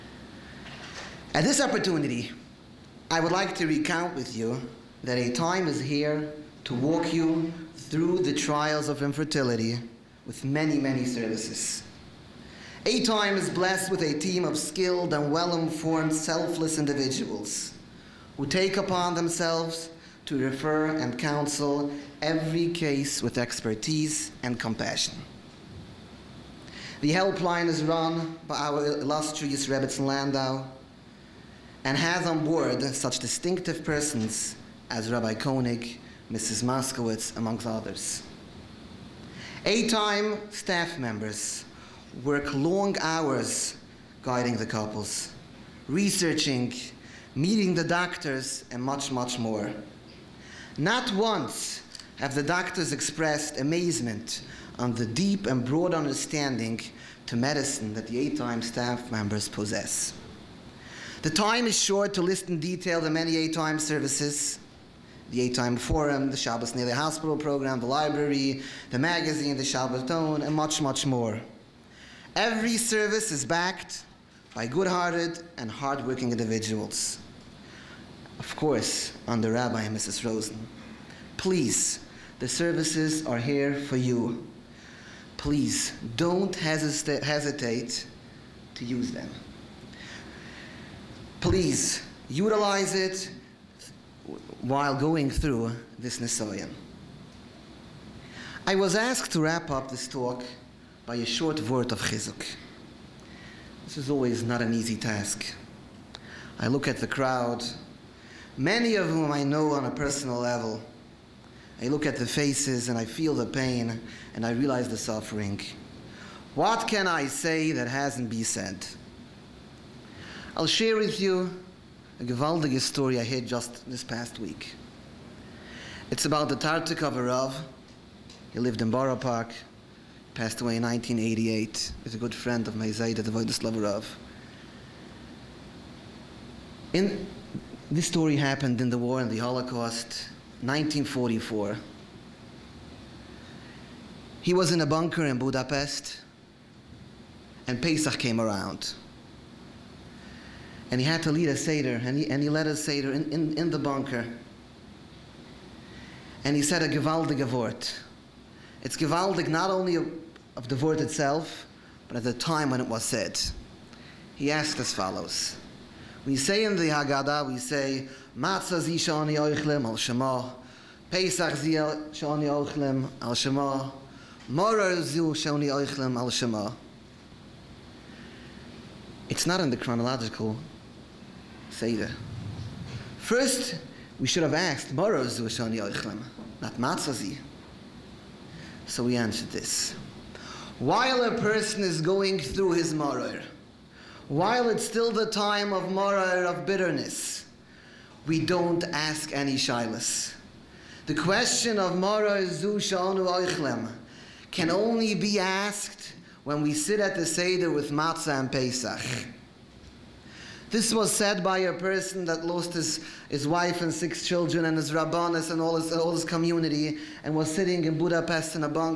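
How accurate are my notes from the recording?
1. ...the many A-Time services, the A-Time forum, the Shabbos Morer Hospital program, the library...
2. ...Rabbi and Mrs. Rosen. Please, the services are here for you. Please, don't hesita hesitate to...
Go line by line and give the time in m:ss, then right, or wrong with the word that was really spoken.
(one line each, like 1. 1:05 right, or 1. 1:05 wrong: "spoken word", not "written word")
1. 1:03 wrong: "Nele", not "Morer"
2. 1:19 right.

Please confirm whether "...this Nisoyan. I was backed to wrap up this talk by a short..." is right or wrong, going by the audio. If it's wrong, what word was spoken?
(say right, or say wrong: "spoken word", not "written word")
wrong: "asked", not "backed".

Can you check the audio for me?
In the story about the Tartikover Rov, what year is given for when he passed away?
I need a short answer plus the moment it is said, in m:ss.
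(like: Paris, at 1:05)
1988, at 2:10.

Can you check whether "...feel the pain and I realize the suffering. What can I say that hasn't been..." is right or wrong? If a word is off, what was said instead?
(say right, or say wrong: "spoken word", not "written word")
right.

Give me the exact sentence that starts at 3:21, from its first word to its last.
The question of Moror Zu Shanu Oichlem can only be asked when we sit at the Seder with Matzah and Pesach.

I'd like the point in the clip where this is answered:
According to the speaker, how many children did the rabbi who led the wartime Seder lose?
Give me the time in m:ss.
3:33.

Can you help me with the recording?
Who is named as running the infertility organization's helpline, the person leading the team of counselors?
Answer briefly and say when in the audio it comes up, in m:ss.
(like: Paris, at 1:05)
Rebbetzin Landau, at 0:29.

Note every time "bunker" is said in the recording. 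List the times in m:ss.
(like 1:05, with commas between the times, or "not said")
2:24, 2:33.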